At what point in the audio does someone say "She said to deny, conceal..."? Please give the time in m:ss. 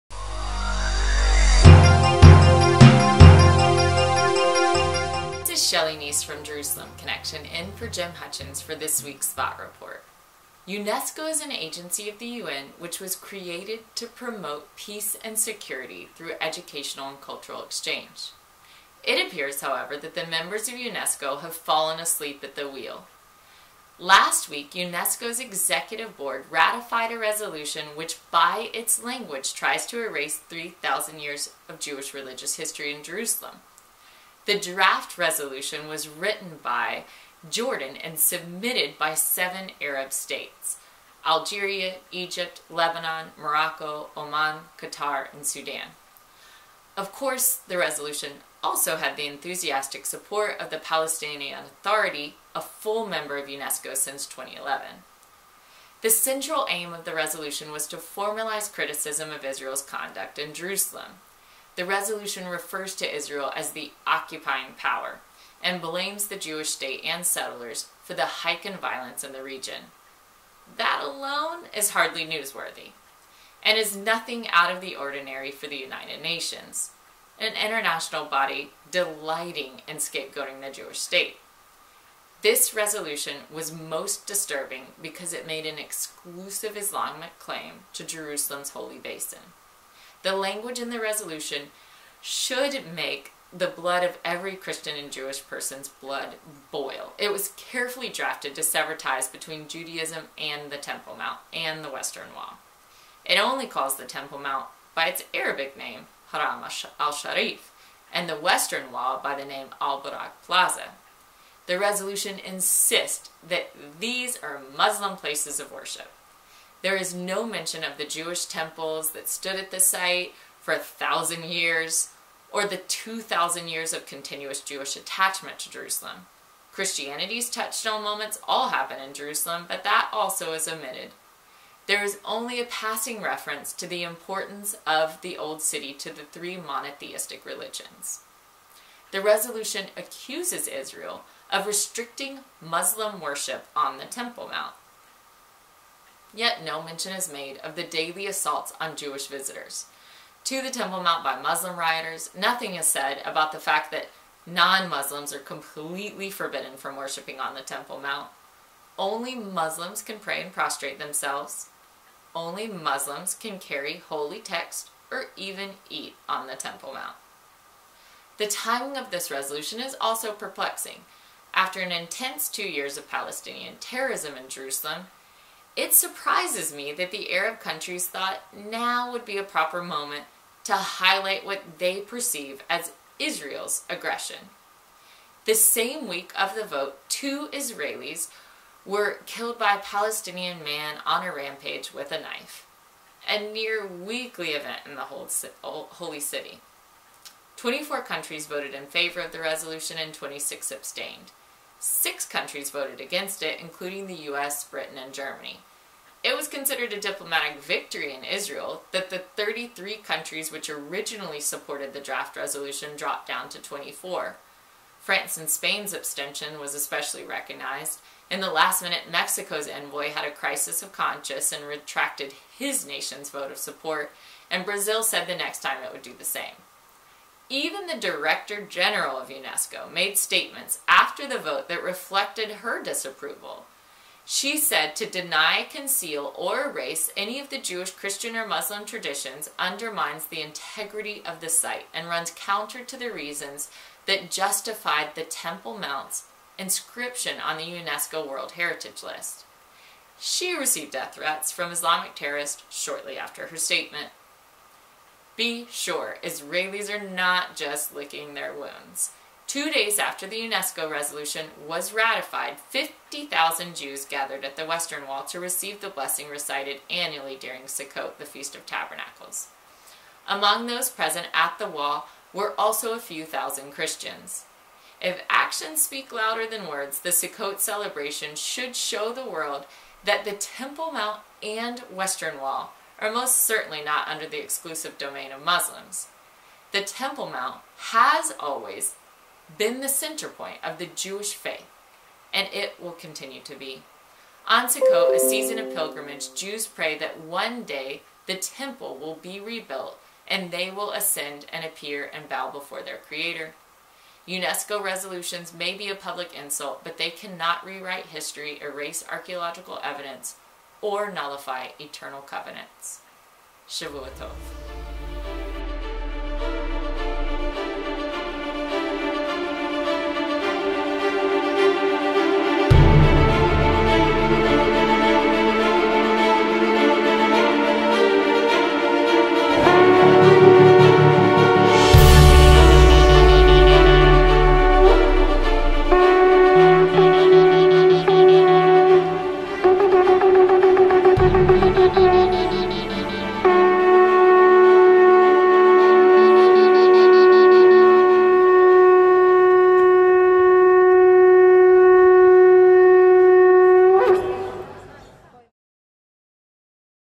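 3:54.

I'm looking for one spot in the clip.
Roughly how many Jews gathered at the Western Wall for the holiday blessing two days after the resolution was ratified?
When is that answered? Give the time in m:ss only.
4:22.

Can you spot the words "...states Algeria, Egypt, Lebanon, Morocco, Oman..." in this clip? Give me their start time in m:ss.
0:40.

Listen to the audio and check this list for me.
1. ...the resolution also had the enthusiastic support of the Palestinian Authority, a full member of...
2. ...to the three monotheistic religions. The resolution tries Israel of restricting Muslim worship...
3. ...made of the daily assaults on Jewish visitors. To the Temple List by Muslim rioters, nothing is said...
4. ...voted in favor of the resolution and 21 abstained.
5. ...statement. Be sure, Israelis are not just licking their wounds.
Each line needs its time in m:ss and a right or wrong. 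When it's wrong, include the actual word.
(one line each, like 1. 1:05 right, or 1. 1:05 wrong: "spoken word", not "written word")
1. 0:47 right
2. 2:15 wrong: "accuses", not "tries"
3. 2:27 wrong: "Mount", not "List"
4. 3:18 wrong: "26", not "21"
5. 4:13 right.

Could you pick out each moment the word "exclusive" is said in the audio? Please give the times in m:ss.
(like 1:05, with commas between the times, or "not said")
1:25, 4:44.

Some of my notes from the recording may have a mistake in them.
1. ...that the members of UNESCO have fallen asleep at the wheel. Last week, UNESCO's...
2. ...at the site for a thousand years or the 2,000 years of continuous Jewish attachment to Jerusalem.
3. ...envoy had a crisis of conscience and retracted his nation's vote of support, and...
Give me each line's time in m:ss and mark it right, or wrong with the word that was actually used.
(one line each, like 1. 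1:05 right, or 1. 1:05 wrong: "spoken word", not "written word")
1. 0:19 right
2. 1:59 right
3. 3:39 right.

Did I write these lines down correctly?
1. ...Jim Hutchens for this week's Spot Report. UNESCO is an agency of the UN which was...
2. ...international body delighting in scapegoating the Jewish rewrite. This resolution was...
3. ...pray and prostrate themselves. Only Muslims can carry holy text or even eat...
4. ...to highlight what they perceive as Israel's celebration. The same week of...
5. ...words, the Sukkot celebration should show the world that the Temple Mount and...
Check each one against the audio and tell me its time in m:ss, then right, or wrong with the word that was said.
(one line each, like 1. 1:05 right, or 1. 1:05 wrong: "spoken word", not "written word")
1. 0:07 right
2. 1:17 wrong: "state", not "rewrite"
3. 2:40 right
4. 3:00 wrong: "aggression", not "celebration"
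5. 4:36 right.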